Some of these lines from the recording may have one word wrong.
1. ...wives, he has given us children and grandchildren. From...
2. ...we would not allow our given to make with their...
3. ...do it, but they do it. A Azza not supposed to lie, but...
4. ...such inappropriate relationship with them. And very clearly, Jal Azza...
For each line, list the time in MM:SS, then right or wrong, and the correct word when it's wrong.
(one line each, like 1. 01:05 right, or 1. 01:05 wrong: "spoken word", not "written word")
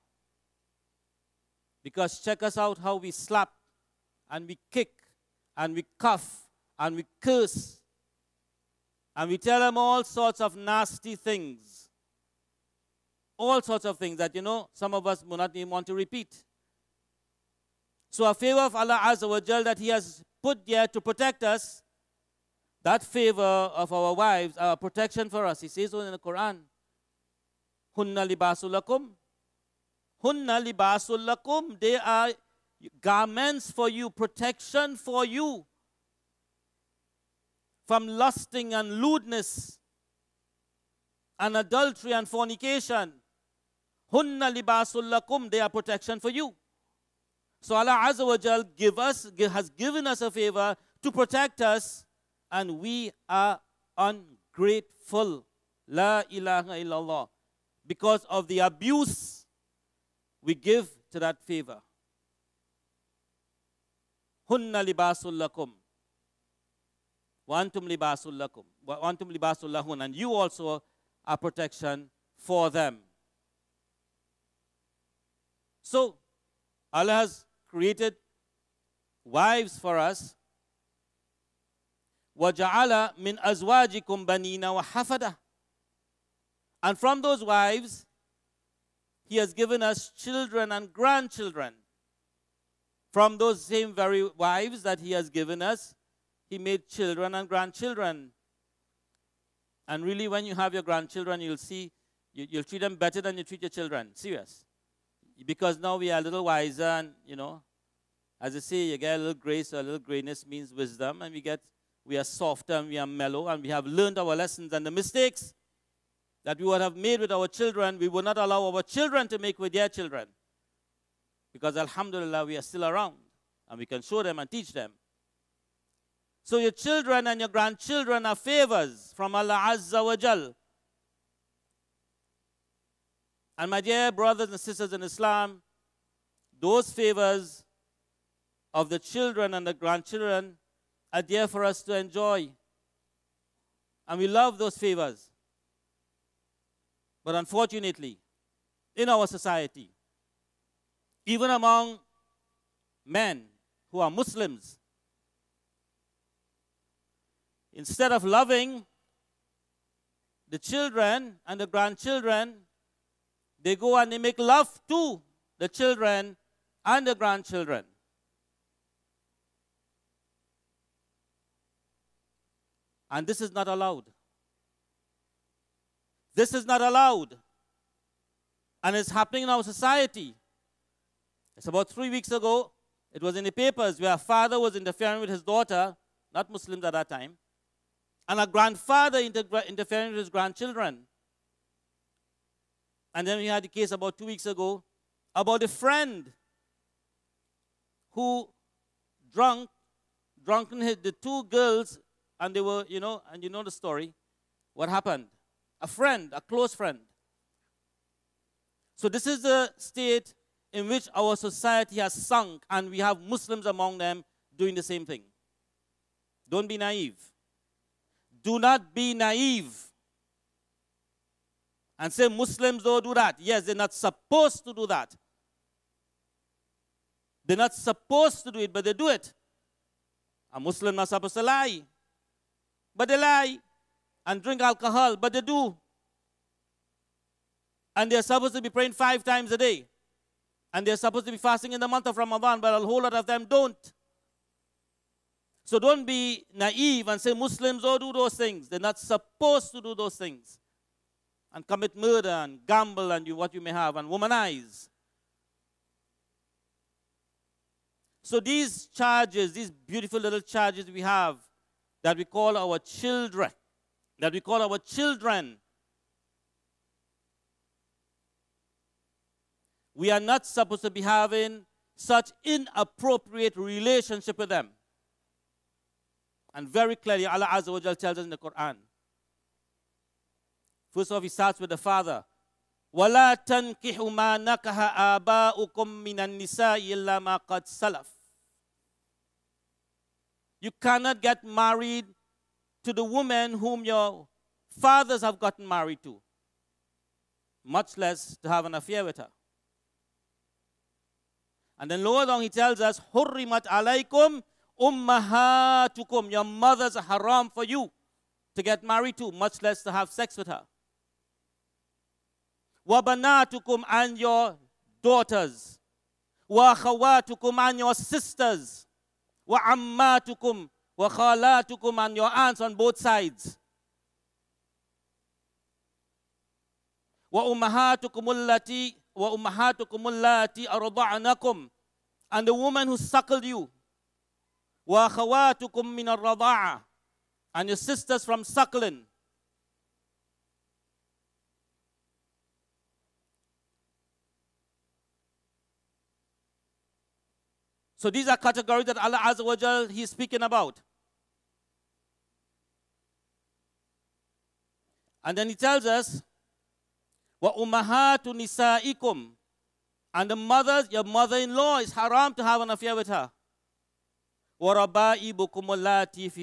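1. 01:27 right
2. 01:57 wrong: "children", not "given"
3. 03:48 wrong: "Muslim", not "Azza"
4. 04:31 wrong: "Allah", not "Jal".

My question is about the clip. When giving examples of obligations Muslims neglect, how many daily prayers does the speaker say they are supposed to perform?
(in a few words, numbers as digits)
5 times a day.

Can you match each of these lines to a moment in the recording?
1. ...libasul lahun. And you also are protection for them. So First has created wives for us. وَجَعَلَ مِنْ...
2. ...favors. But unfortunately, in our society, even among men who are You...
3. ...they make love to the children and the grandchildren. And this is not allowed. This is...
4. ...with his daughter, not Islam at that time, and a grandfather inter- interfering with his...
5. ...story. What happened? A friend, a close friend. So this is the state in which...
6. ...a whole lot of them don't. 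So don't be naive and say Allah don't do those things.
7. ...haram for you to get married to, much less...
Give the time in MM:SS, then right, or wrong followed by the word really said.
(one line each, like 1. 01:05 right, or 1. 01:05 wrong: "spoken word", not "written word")
1. 01:09 wrong: "Allah", not "First"
2. 02:24 wrong: "Muslims", not "You"
3. 02:44 right
4. 03:05 wrong: "Muslims", not "Islam"
5. 03:23 right
6. 04:02 wrong: "Muslims", not "Allah"
7. 05:07 right.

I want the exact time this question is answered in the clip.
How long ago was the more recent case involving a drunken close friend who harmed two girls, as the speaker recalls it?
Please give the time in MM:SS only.
03:13.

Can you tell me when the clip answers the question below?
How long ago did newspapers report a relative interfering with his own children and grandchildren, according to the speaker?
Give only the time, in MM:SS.
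03:01.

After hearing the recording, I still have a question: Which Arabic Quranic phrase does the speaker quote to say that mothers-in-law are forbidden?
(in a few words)
Wa ummahatu nisaikum.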